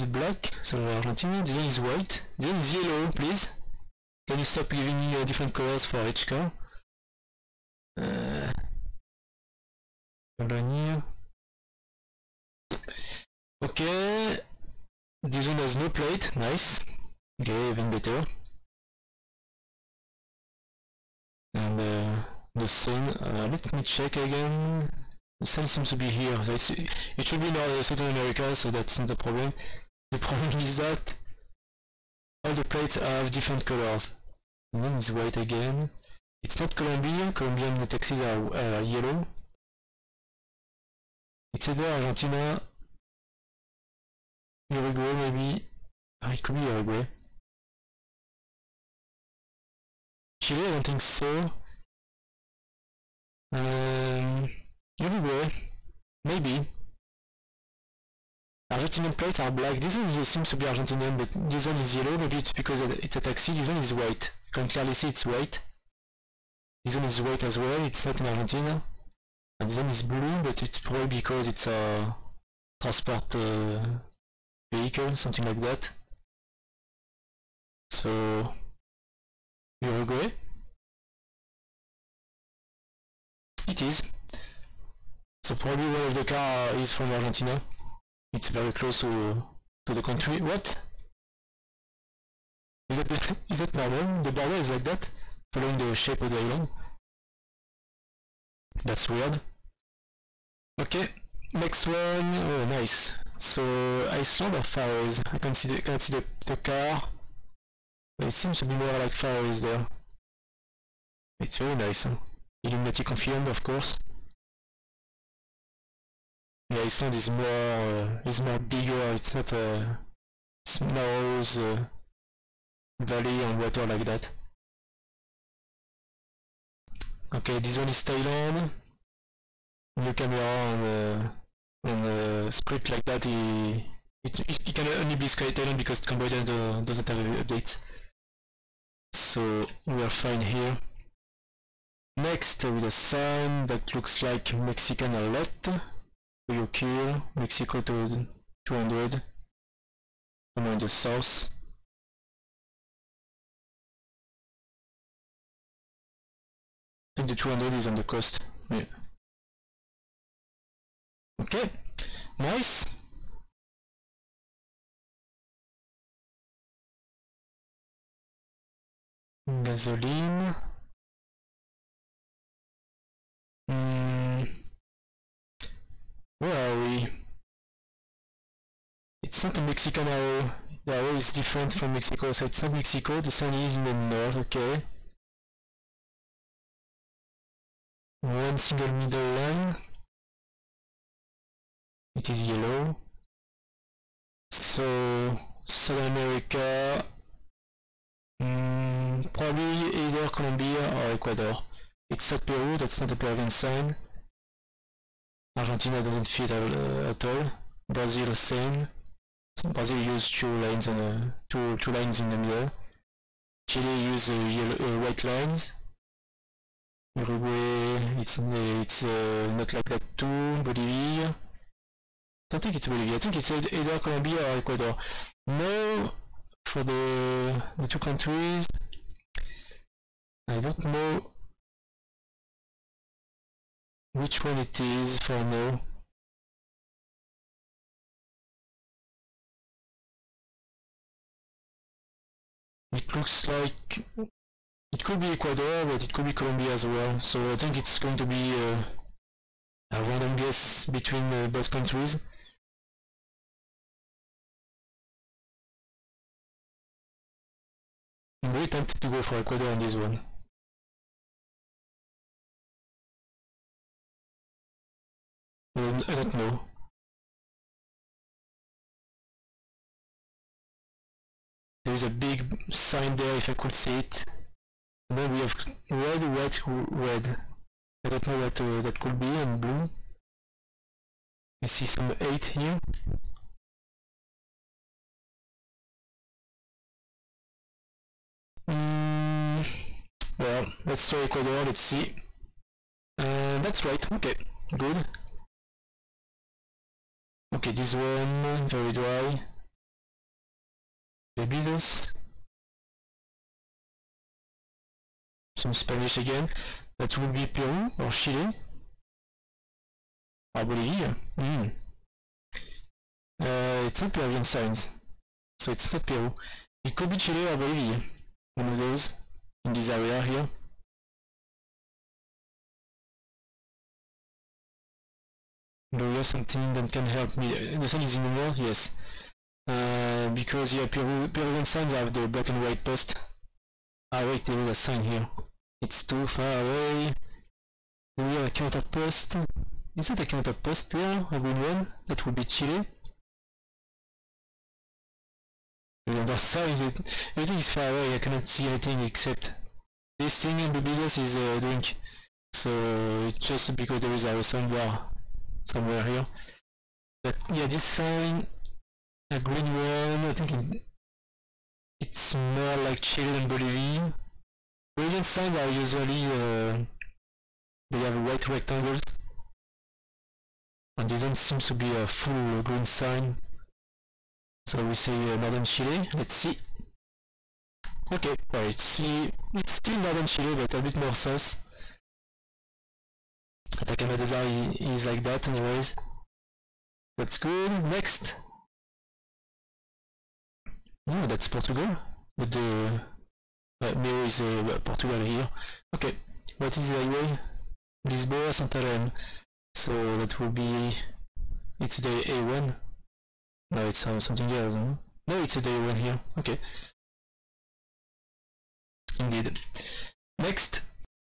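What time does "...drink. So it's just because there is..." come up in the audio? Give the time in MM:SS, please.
05:51.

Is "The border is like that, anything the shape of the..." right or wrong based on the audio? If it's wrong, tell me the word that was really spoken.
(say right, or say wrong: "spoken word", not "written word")
wrong: "following", not "anything".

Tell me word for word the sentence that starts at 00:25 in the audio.
The sun seems to be here.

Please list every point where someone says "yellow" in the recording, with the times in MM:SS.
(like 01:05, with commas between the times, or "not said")
00:02, 00:38, 01:01, 03:12, 03:34.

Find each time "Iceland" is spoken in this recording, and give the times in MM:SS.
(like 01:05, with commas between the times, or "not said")
01:44, 01:56.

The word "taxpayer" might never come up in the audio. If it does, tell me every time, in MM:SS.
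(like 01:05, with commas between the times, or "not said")
not said.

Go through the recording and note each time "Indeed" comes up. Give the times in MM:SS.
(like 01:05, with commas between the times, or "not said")
06:49.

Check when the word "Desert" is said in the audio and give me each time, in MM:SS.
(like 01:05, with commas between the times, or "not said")
06:24.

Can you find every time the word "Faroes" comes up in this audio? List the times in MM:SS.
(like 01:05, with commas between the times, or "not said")
01:44, 01:49.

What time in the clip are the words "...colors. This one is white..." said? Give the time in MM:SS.
00:33.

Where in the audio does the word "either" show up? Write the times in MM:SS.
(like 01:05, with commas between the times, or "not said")
00:41, 03:19, 03:43.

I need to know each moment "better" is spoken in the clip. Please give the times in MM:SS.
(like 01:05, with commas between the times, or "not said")
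00:17.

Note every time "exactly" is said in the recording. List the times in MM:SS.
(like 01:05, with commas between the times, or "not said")
not said.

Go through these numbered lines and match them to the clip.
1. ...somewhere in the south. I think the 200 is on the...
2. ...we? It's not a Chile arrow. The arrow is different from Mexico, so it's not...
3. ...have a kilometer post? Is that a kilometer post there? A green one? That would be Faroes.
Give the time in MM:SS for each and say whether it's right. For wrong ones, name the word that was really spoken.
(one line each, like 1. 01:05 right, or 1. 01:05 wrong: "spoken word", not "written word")
1. 02:30 right
2. 02:56 wrong: "Mexican", not "Chile"
3. 05:38 wrong: "Chile", not "Faroes".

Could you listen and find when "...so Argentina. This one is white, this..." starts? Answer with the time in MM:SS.
00:00.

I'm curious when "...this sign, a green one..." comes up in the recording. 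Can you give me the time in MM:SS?
05:57.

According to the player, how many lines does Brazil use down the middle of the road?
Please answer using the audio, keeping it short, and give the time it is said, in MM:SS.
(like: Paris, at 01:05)
2, at 03:31.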